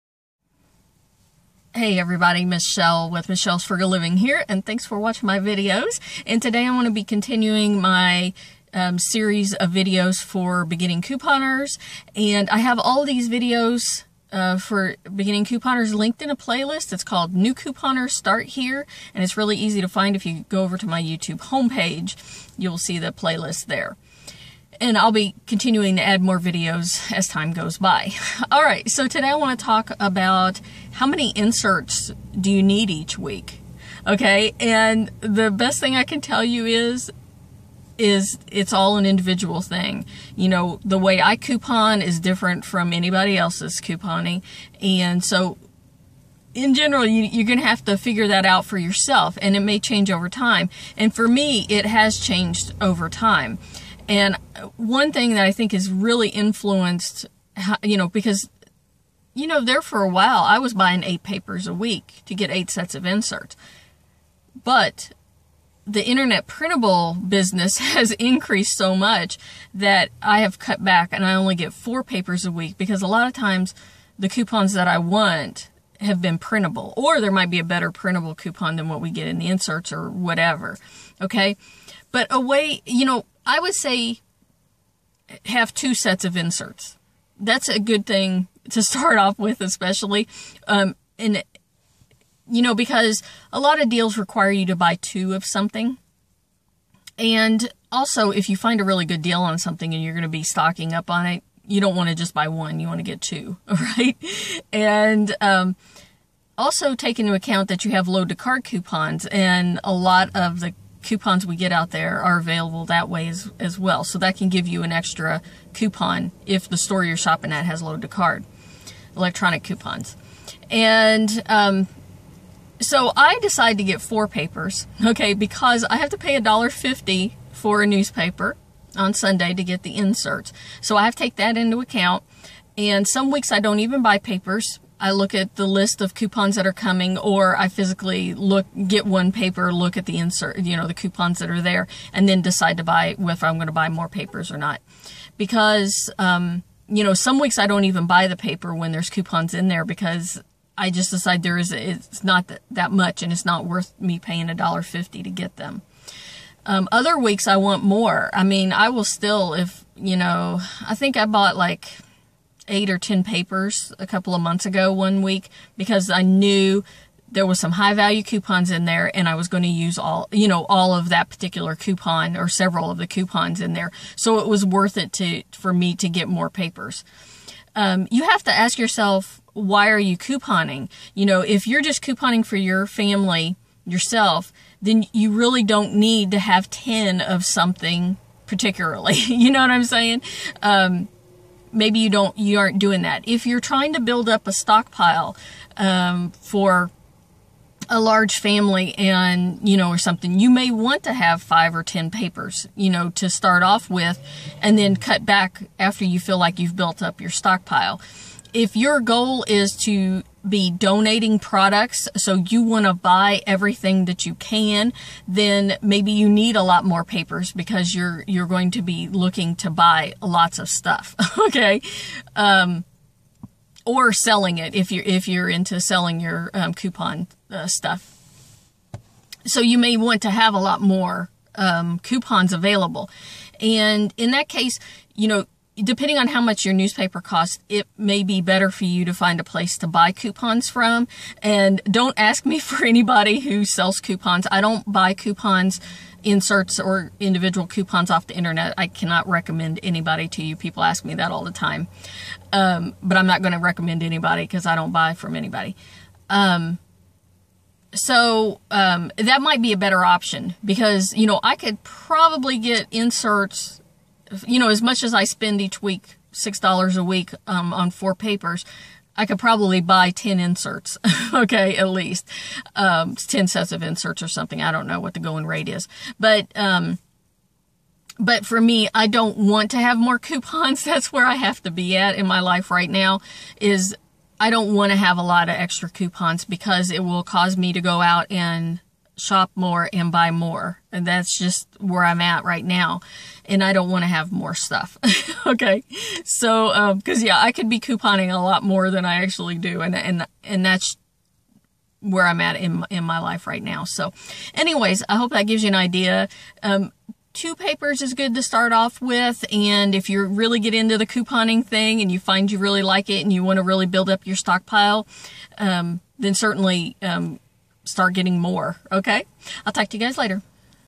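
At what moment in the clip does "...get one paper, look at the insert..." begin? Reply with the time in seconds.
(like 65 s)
138 s.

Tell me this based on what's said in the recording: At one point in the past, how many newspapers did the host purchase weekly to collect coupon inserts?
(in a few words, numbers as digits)
8.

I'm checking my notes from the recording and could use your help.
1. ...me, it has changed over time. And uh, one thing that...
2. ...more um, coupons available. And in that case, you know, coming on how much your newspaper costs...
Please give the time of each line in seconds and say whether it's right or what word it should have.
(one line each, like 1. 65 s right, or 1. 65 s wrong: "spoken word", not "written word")
1. 51 s right
2. 230 s wrong: "depending", not "coming".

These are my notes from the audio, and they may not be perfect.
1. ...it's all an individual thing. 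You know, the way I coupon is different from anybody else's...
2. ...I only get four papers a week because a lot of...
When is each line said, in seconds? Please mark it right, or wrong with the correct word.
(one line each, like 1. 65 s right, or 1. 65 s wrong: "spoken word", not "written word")
1. 38 s right
2. 71 s right.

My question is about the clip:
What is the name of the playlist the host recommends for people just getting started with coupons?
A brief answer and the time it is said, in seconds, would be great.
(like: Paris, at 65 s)
New Couponers Start Here, at 17 s.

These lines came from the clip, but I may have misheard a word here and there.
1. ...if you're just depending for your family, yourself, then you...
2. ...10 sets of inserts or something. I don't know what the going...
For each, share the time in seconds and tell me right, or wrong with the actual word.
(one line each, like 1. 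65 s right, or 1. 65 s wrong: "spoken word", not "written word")
1. 181 s wrong: "couponing", not "depending"
2. 273 s right.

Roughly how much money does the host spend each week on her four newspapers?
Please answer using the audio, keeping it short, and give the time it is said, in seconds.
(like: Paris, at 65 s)
$6, at 266 s.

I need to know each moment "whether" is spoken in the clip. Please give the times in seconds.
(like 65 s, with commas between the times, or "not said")
143 s.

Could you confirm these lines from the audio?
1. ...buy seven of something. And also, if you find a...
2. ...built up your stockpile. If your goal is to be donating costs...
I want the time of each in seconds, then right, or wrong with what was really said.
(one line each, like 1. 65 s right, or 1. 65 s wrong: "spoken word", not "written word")
1. 94 s wrong: "two", not "seven"
2. 206 s wrong: "products", not "costs".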